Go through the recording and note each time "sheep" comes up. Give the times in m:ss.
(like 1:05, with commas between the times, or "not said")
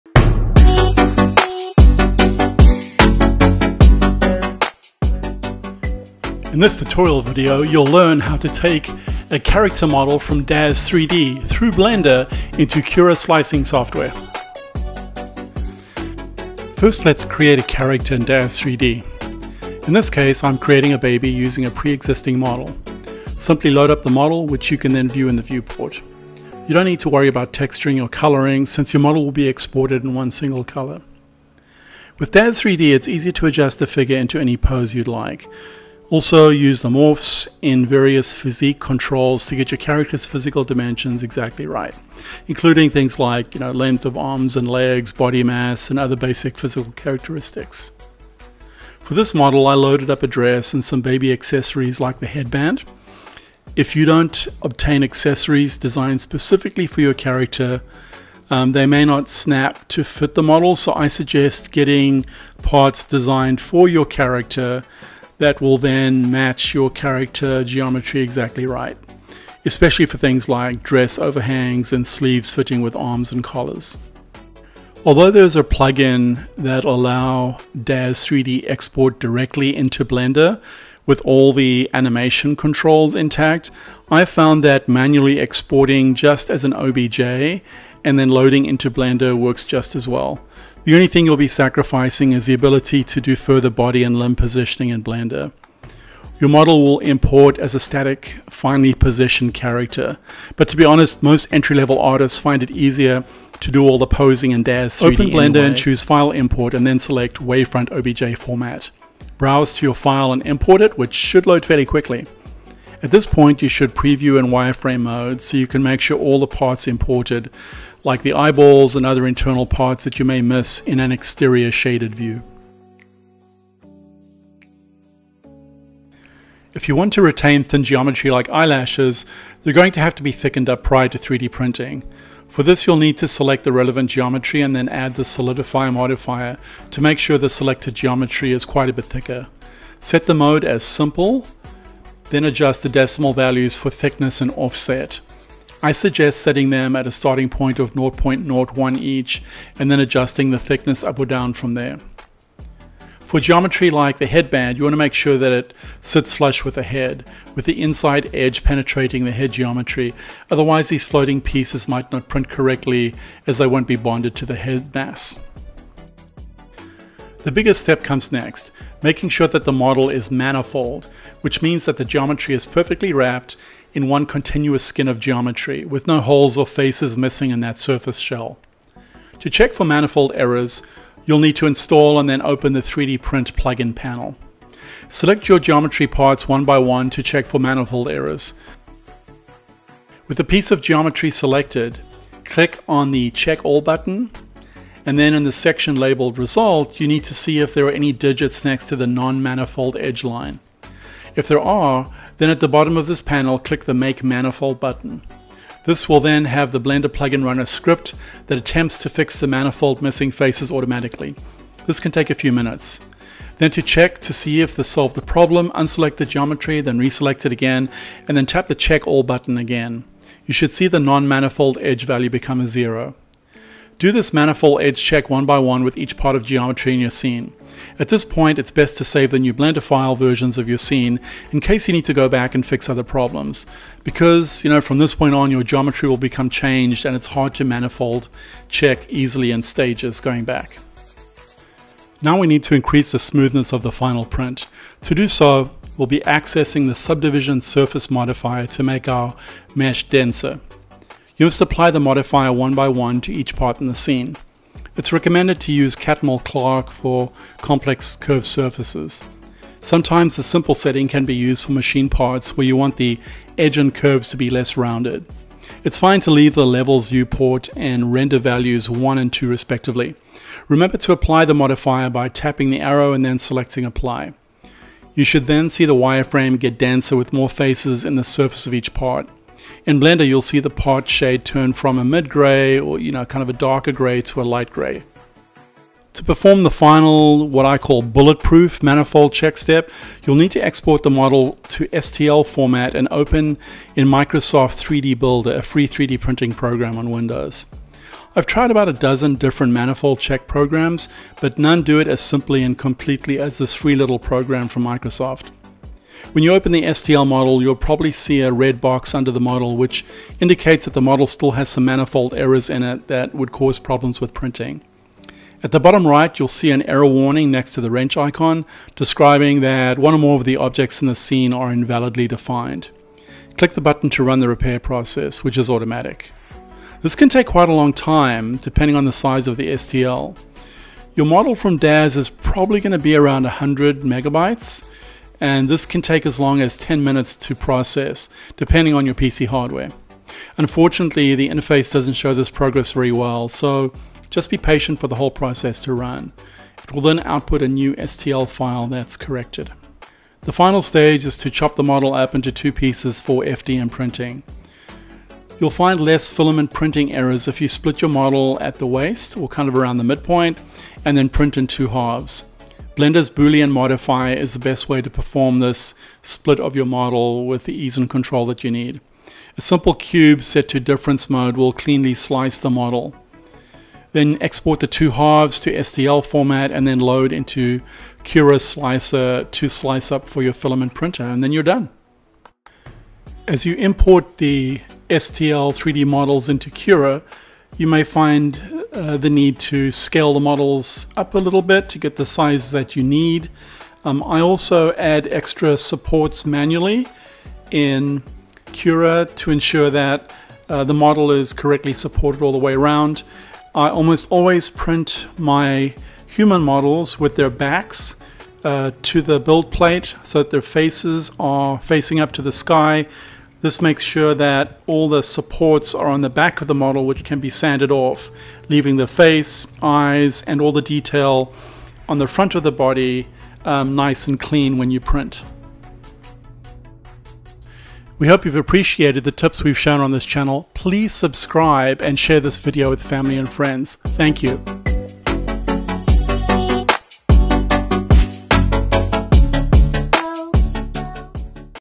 not said.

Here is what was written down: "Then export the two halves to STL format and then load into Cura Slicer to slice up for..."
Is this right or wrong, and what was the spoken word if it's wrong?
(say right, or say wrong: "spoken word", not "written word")
right.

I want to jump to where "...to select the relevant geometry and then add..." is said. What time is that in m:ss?
2:13.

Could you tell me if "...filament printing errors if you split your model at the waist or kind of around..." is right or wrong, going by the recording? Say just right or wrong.
right.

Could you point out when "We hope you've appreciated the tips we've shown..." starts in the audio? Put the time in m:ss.
7:08.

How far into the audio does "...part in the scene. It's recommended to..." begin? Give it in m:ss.
4:13.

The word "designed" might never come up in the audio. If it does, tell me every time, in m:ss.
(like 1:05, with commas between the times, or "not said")
0:55, 1:03.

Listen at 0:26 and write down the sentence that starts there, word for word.
You don't need to worry about texturing or coloring since your model will be exported in one single color.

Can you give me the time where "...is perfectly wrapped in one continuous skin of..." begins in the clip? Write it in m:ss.
2:52.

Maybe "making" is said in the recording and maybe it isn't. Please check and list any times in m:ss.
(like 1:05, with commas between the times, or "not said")
2:49.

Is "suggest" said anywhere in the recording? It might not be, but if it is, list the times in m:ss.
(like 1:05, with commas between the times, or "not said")
1:01, 2:25.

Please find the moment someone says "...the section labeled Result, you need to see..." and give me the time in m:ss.
3:15.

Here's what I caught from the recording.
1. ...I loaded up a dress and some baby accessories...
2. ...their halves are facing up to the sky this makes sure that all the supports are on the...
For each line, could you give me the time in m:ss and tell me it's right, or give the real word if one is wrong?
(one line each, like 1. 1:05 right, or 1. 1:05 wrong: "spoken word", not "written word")
1. 0:49 right
2. 6:50 wrong: "faces", not "halves".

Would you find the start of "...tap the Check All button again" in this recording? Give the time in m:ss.
3:38.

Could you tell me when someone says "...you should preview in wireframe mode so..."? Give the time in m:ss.
1:53.